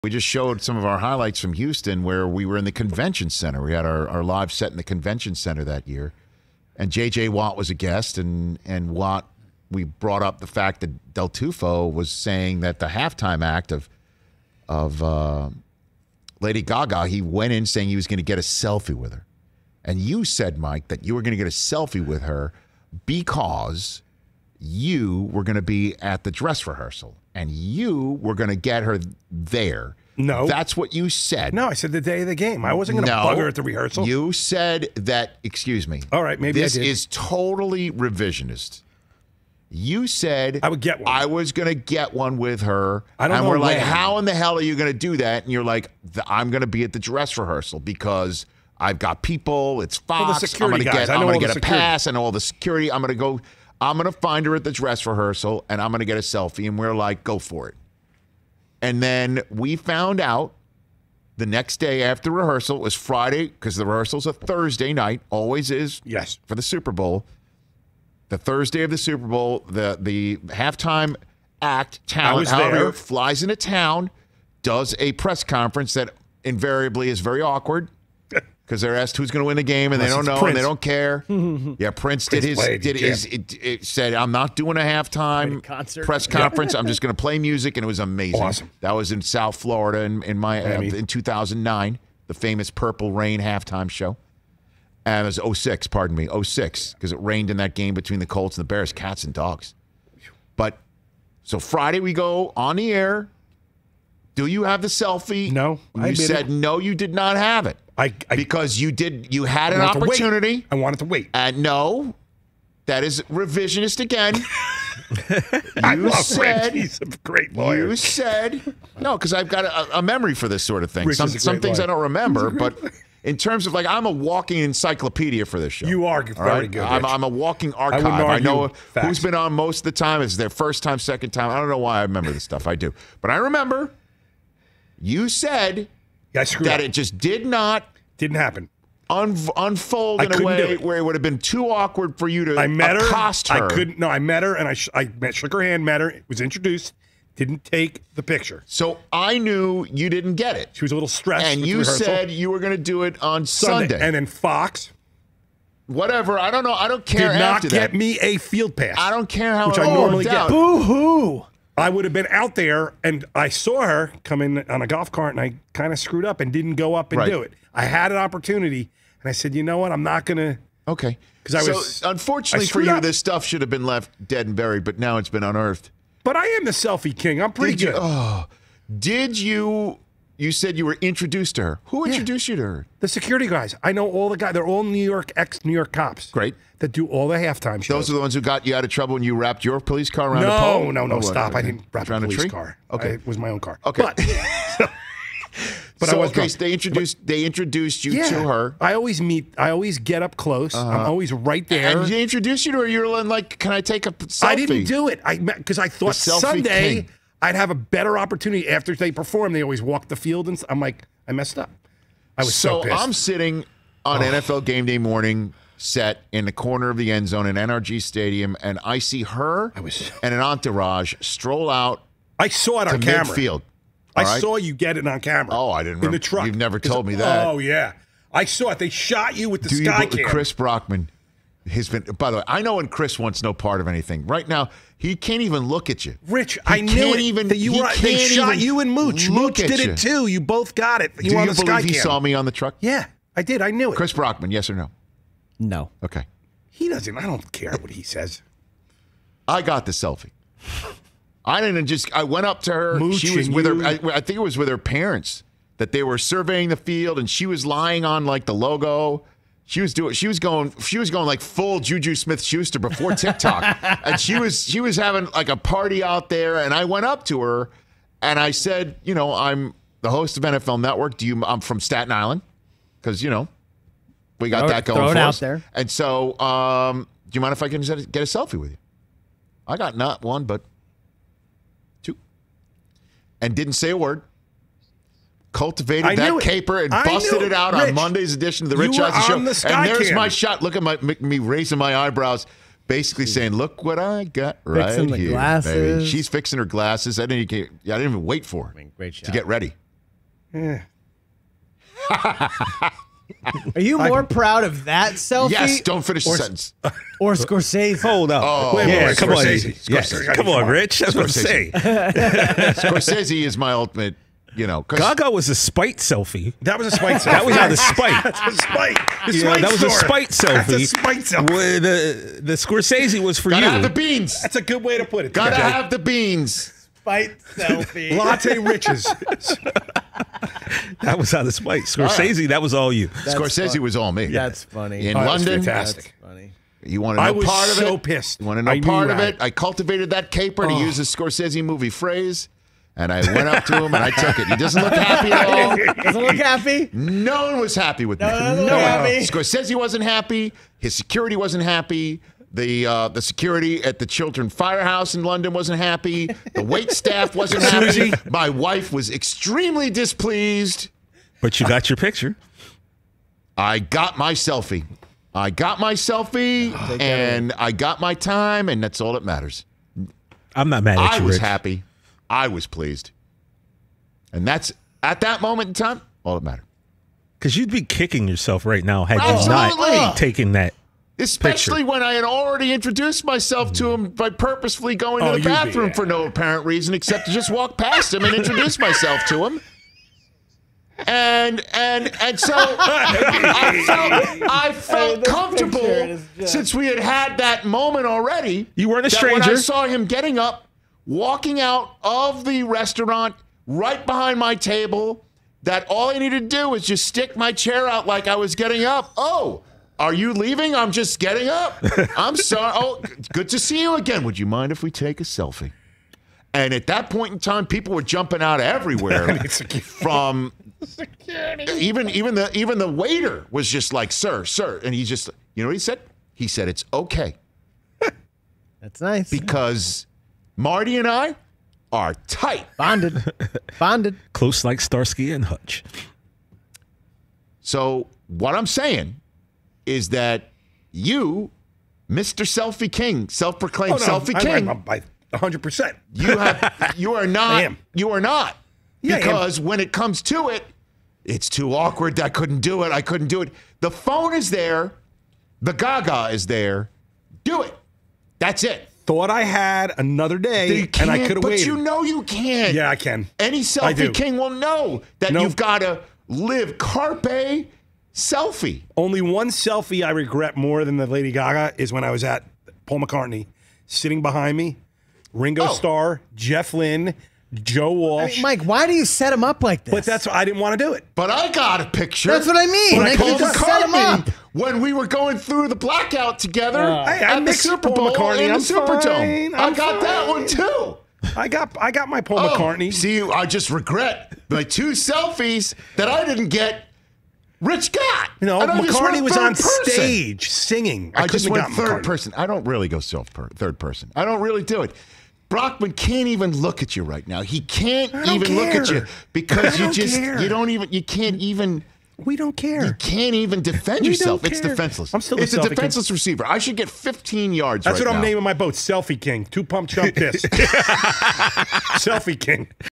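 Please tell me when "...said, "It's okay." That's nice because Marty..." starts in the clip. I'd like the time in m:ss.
7:06.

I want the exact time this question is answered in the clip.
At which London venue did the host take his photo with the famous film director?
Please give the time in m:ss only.
5:54.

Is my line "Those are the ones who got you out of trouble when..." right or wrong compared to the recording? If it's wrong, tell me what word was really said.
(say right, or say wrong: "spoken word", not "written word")
right.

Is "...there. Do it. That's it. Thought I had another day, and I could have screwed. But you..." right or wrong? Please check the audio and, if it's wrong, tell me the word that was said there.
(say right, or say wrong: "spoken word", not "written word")
wrong: "waited", not "screwed".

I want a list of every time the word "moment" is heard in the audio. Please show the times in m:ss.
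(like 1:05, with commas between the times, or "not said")
6:15, 6:37.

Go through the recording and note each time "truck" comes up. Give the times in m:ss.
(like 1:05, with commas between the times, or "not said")
3:46, 4:02.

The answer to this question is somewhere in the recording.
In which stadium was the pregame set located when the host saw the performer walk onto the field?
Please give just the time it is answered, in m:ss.
3:37.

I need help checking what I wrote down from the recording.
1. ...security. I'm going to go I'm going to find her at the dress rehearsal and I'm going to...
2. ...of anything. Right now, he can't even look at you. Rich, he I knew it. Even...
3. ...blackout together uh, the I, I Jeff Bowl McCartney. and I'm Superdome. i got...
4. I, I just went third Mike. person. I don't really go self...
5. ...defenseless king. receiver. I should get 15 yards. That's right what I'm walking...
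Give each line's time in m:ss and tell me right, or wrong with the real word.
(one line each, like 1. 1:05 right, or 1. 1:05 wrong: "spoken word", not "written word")
1. 0:52 right
2. 3:53 right
3. 8:05 wrong: "Super", not "Jeff"
4. 8:21 wrong: "McCartney", not "Mike"
5. 8:35 wrong: "naming", not "walking".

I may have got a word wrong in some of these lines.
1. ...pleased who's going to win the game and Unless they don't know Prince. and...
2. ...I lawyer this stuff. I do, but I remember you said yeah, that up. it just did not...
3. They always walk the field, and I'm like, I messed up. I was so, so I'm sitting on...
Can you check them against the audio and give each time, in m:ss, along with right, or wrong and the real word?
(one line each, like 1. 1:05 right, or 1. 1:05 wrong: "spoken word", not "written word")
1. 1:18 wrong: "asked", not "pleased"
2. 2:11 wrong: "remember", not "lawyer"
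3. 3:29 right.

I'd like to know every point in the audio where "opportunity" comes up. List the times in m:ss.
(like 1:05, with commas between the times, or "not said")
1:49, 2:48, 3:28.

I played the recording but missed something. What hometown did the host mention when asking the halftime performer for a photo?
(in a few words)
Staten Island.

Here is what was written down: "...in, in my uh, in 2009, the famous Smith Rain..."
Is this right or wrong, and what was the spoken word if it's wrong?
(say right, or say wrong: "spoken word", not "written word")
wrong: "Purple", not "Smith".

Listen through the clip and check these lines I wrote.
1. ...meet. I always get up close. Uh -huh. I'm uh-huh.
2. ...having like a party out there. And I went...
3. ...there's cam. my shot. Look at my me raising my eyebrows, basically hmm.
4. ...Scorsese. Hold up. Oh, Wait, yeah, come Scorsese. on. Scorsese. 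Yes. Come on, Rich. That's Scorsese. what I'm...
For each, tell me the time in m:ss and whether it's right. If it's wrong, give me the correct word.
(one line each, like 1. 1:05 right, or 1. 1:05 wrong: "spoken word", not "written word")
1. 3:19 right
2. 4:24 right
3. 4:49 right
4. 5:07 right.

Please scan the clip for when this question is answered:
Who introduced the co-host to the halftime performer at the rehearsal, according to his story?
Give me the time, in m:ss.
3:02.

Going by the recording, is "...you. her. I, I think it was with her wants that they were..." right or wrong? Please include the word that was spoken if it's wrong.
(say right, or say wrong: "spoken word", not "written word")
wrong: "parents", not "wants".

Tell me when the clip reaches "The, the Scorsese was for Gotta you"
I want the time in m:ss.
5:21.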